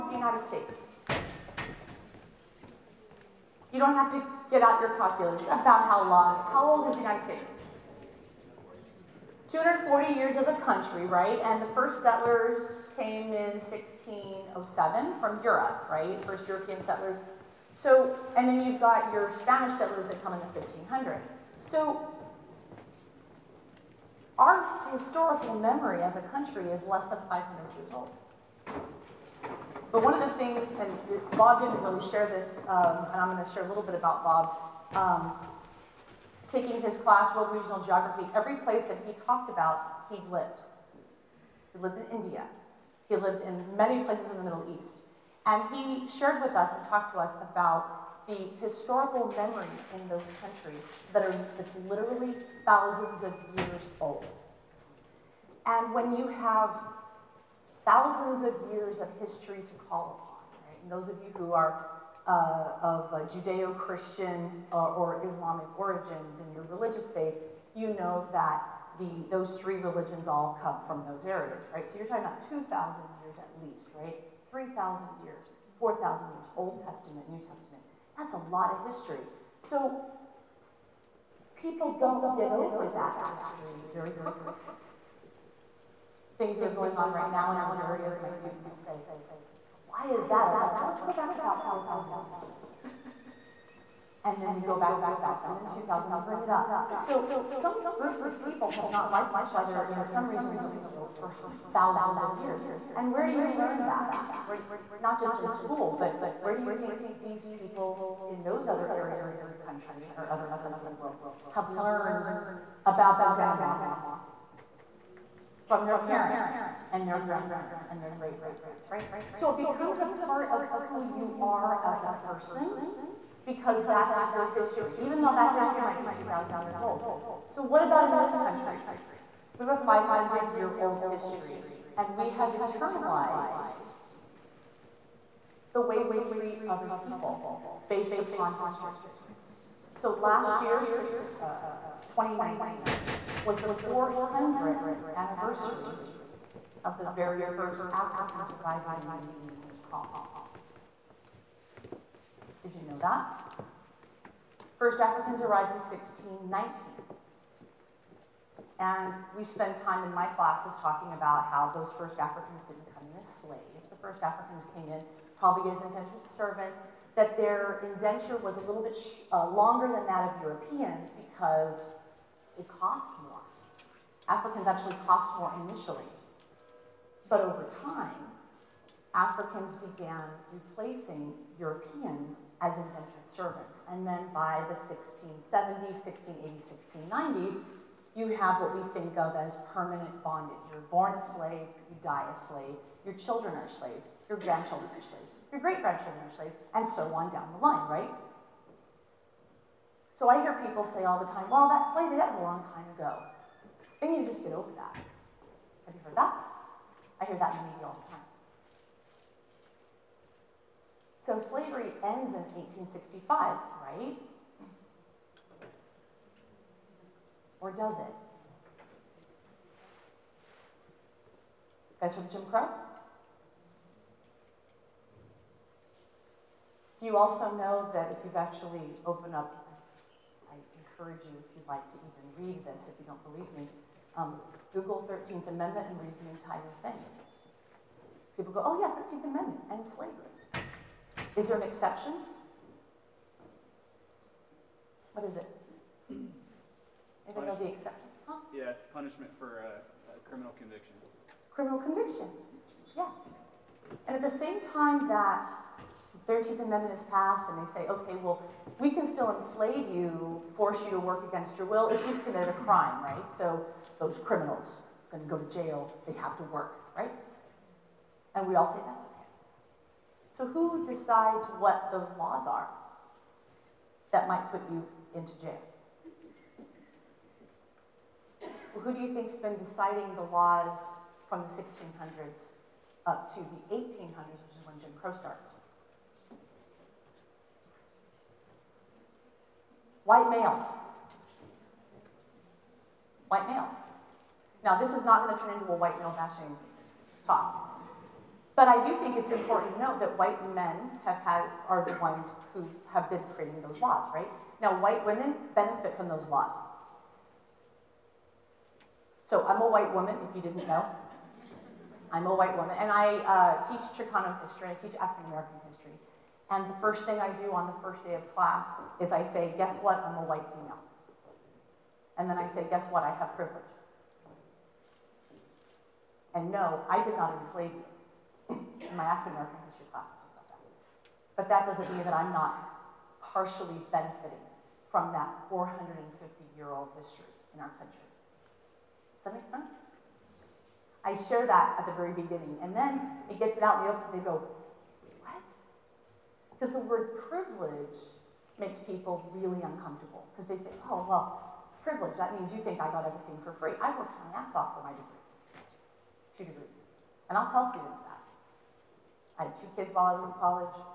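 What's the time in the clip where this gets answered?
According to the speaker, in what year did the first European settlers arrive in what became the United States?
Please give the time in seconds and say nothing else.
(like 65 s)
13 s.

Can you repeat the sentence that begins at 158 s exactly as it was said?
And we spend time in my classes talking about how those first Africans didn't come in as slaves.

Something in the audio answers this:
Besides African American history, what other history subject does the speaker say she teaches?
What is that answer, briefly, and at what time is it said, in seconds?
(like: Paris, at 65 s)
Chicano history, at 313 s.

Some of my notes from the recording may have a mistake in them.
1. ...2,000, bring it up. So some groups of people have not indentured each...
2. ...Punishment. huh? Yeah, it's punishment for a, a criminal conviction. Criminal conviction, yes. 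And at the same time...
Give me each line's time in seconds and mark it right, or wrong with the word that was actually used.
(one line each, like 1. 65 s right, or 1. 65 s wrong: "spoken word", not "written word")
1. 95 s wrong: "liked", not "indentured"
2. 247 s right.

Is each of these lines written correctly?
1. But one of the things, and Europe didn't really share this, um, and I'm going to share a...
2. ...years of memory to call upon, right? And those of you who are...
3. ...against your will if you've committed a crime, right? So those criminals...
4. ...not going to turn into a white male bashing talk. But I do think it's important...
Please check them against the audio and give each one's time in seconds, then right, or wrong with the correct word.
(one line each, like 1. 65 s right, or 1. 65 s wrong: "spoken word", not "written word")
1. 29 s wrong: "Bob", not "Europe"
2. 58 s wrong: "history", not "memory"
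3. 261 s right
4. 295 s right.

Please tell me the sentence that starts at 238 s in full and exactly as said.
People go, oh yeah, 13th Amendment and slavery.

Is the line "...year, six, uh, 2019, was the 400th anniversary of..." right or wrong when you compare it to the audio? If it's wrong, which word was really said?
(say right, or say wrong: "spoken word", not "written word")
right.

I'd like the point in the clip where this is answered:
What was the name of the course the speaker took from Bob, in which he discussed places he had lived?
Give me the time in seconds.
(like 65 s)
37 s.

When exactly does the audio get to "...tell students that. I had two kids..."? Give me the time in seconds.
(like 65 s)
357 s.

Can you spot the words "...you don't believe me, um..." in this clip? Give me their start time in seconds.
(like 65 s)
232 s.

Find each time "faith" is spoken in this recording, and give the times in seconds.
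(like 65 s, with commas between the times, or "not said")
67 s.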